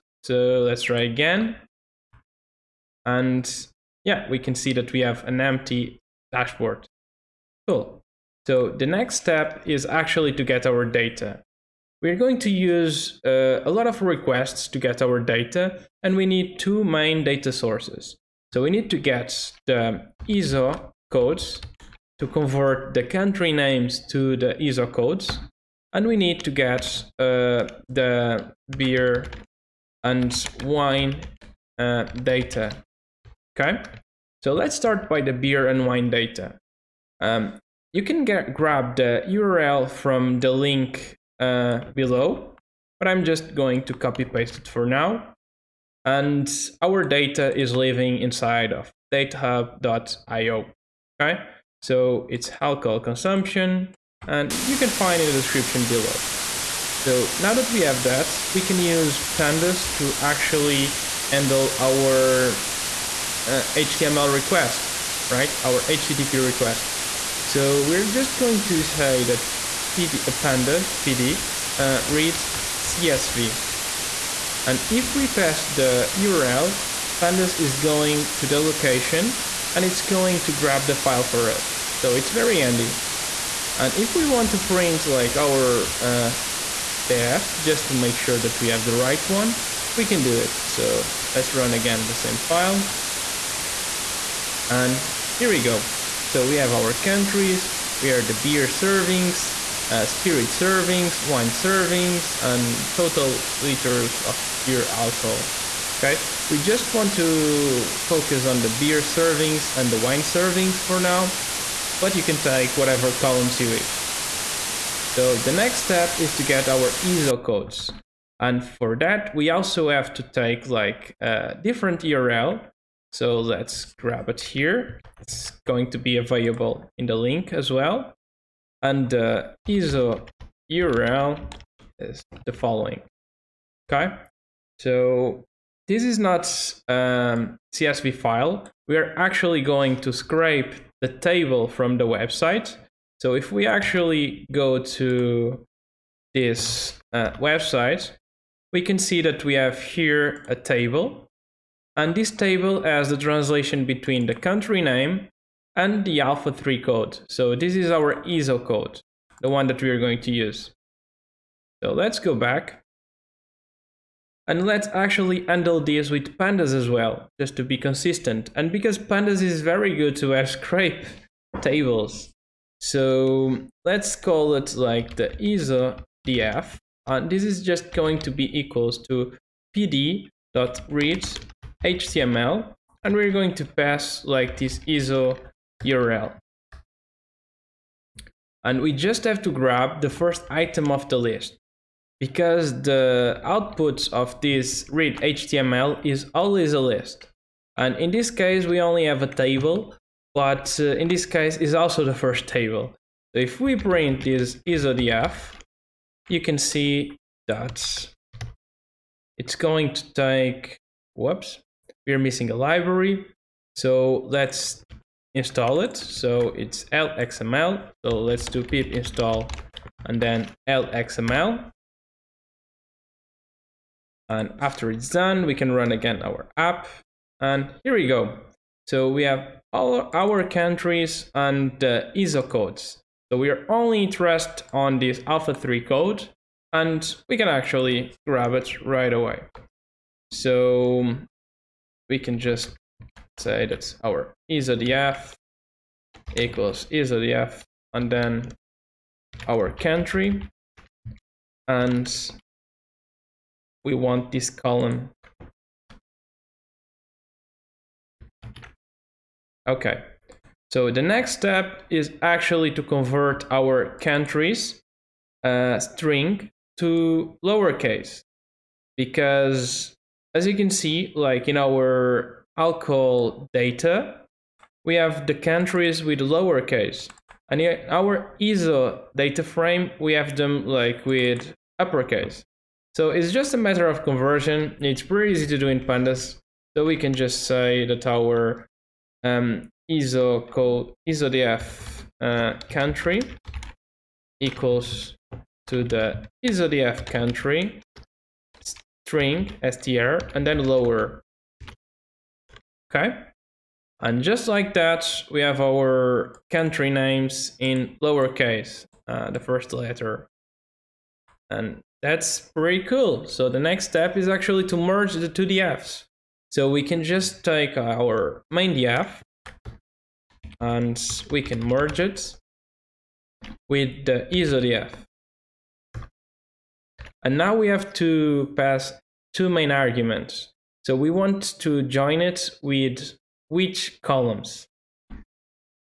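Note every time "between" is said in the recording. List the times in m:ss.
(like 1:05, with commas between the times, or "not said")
2:33.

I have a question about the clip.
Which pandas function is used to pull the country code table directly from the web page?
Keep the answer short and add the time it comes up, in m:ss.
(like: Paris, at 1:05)
read HTML, at 3:14.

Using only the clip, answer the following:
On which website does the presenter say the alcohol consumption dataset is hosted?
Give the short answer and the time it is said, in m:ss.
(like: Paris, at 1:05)
datahub.io, at 0:49.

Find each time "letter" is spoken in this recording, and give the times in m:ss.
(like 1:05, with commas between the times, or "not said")
5:09.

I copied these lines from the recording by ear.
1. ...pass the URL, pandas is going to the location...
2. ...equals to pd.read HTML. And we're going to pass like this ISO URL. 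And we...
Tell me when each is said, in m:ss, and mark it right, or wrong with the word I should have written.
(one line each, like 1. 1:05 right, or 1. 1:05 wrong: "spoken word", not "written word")
1. 1:15 right
2. 2:58 right.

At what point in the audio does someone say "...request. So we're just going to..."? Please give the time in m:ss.
1:06.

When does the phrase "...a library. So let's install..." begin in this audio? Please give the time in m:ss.
3:32.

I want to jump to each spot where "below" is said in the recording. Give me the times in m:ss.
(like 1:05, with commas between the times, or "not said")
0:41, 0:55.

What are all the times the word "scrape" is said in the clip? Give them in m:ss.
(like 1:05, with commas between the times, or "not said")
2:20, 2:50.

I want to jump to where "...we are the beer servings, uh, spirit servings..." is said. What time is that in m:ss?
1:38.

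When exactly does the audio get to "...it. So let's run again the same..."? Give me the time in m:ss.
1:30.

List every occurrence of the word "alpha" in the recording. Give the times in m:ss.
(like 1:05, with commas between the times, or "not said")
2:36, 3:55.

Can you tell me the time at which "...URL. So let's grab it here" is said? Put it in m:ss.
2:02.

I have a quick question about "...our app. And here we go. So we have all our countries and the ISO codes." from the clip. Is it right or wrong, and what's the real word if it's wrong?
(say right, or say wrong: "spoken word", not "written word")
right.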